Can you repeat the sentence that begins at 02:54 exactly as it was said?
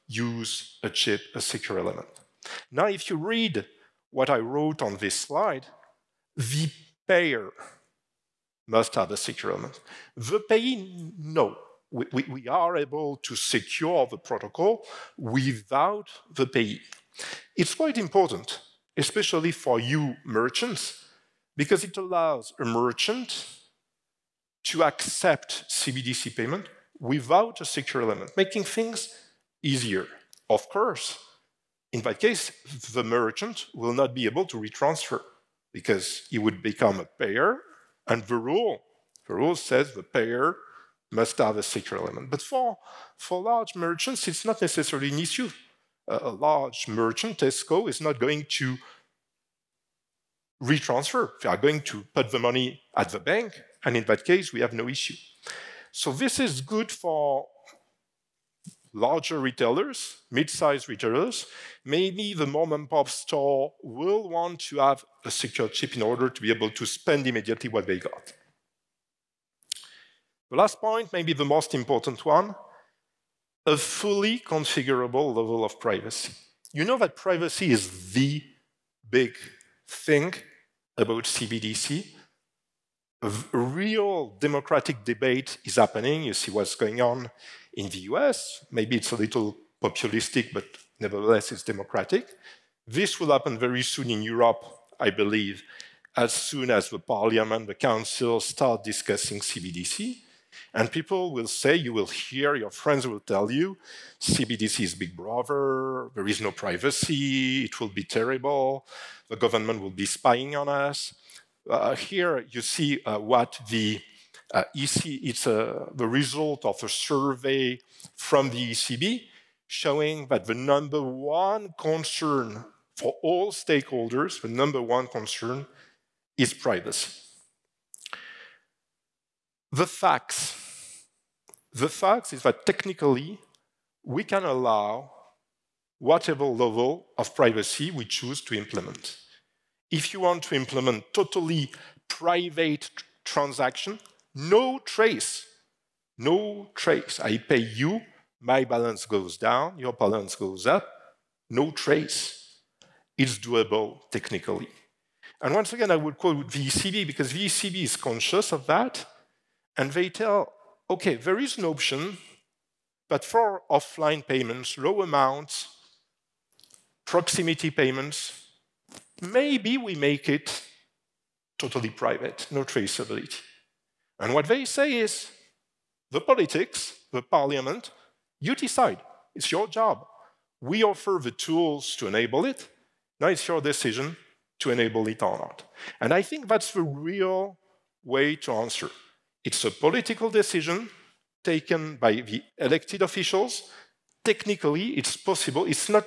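And what they say is, the politics, the parliament, you decide.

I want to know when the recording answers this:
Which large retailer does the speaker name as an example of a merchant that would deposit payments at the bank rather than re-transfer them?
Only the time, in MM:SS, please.
00:47.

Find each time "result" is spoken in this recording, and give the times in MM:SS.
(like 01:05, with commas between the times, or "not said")
01:56.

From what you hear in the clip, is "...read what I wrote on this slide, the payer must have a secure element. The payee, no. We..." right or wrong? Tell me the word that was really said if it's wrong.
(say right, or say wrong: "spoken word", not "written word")
right.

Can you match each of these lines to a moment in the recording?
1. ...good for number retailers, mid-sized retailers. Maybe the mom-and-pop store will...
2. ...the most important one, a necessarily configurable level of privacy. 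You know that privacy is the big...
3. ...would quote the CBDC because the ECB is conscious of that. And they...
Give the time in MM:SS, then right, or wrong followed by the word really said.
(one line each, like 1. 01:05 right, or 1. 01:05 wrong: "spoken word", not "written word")
1. 00:56 wrong: "larger", not "number"
2. 01:11 wrong: "fully", not "necessarily"
3. 02:35 wrong: "ECB", not "CBDC".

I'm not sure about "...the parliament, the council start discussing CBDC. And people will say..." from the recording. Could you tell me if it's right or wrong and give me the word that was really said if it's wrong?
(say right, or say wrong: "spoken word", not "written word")
right.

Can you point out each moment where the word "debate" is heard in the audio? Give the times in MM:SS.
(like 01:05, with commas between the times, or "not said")
01:25.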